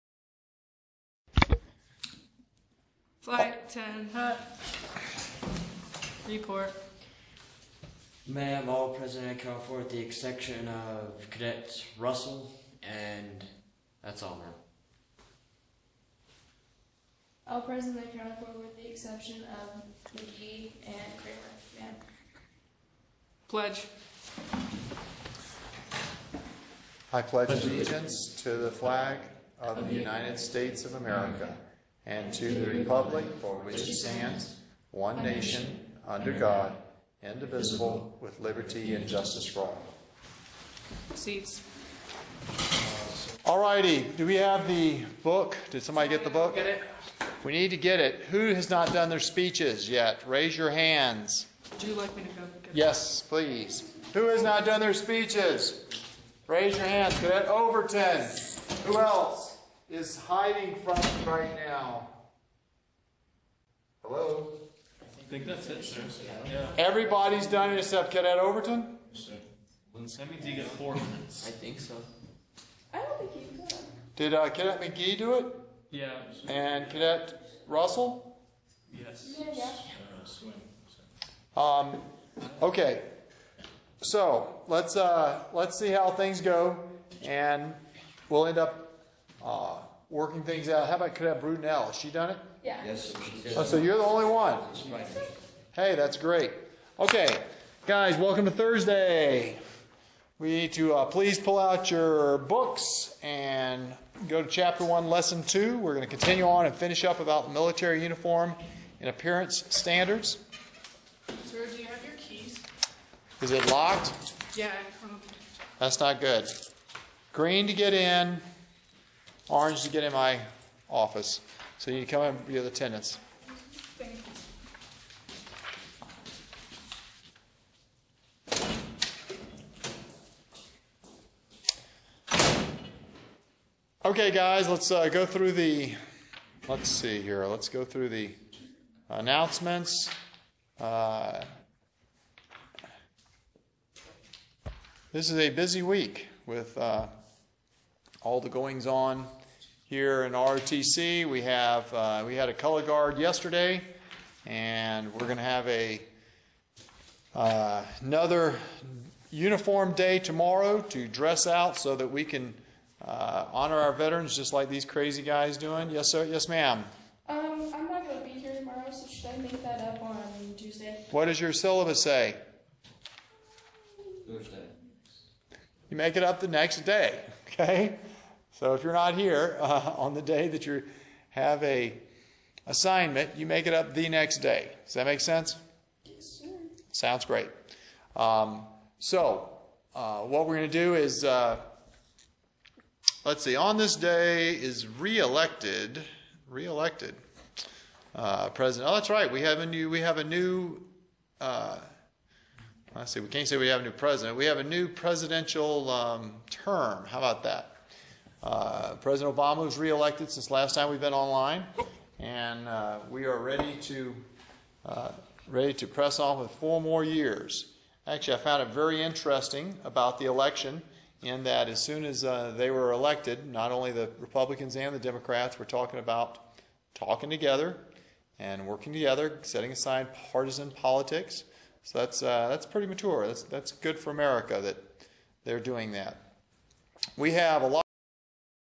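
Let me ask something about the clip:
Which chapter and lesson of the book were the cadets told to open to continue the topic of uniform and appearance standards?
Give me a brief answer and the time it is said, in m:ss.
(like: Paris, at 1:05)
Chapter 1, Lesson 2, at 1:44.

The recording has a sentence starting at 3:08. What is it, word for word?
Um, so uh, what we're going to do is, uh, let's see, on this day is reelected, reelected uh, president.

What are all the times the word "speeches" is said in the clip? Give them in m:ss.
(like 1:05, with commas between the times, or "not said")
0:49, 0:54.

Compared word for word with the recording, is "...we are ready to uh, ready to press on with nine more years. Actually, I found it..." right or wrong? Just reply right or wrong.
wrong.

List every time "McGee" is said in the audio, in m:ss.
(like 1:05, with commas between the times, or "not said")
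0:20, 1:14.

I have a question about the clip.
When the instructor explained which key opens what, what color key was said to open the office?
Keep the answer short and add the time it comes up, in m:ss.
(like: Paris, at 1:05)
Orange, at 1:59.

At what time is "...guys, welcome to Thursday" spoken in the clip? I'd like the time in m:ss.
1:37.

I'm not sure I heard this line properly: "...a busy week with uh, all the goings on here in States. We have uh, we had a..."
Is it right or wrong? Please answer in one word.
wrong.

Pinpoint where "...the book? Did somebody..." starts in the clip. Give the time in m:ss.
0:44.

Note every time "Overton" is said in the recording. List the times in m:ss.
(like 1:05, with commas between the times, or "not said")
0:57, 1:08.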